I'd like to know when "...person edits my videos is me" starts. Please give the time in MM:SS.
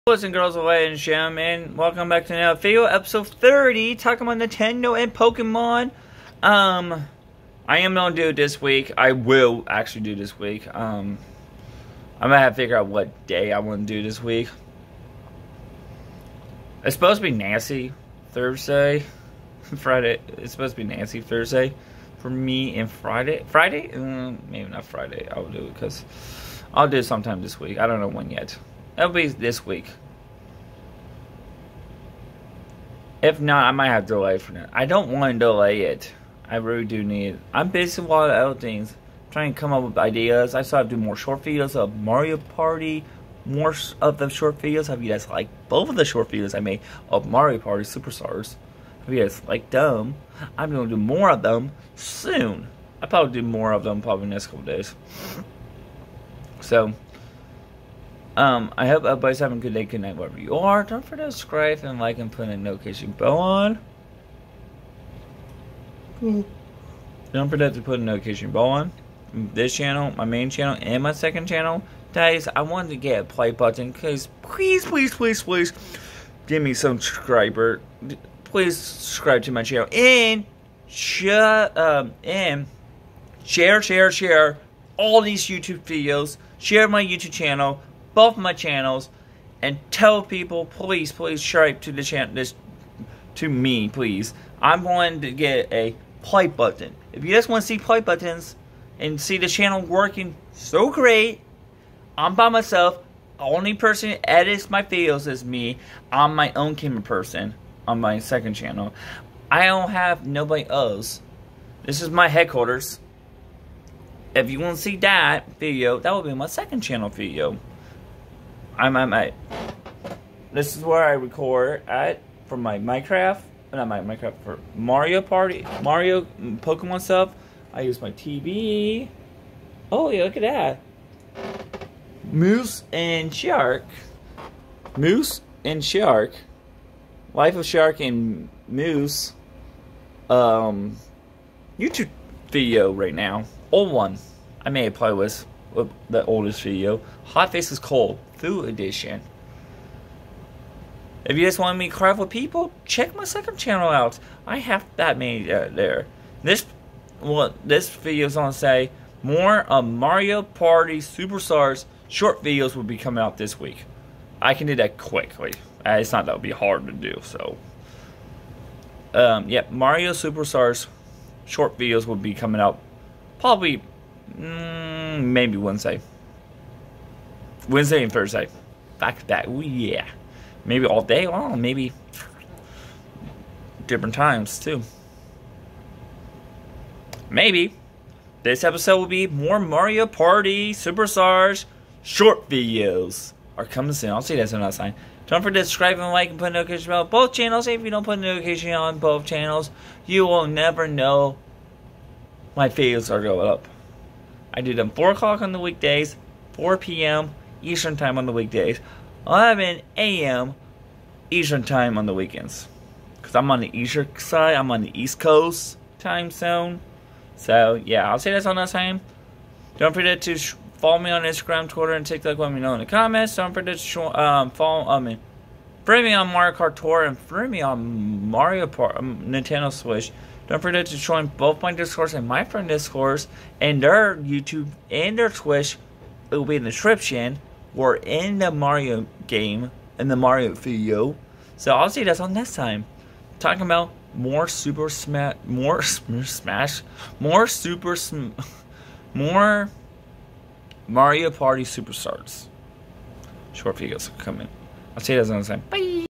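01:43.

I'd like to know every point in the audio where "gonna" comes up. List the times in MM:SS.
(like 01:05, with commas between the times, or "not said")
00:07, 00:12, 02:38.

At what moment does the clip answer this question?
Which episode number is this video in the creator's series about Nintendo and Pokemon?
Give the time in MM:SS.
00:02.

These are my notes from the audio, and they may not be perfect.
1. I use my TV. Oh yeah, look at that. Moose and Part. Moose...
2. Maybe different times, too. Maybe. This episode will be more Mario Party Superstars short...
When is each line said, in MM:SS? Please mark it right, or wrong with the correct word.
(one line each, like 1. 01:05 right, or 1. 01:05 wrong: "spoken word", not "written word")
1. 02:07 wrong: "Shark", not "Part"
2. 03:01 right.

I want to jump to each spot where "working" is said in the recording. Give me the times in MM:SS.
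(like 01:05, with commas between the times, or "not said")
01:39.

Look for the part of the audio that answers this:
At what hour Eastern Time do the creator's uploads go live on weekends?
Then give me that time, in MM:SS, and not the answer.
03:29.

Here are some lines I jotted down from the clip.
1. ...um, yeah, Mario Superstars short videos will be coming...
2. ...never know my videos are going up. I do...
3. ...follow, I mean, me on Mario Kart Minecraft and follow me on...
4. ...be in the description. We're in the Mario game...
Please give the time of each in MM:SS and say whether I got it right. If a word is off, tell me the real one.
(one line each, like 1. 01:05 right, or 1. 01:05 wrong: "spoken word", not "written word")
1. 02:49 right
2. 03:20 right
3. 03:44 wrong: "Tour", not "Minecraft"
4. 03:56 right.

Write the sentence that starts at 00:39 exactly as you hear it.
trying to come up with ideas.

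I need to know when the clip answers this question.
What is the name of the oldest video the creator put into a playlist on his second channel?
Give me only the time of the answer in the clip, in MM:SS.
02:27.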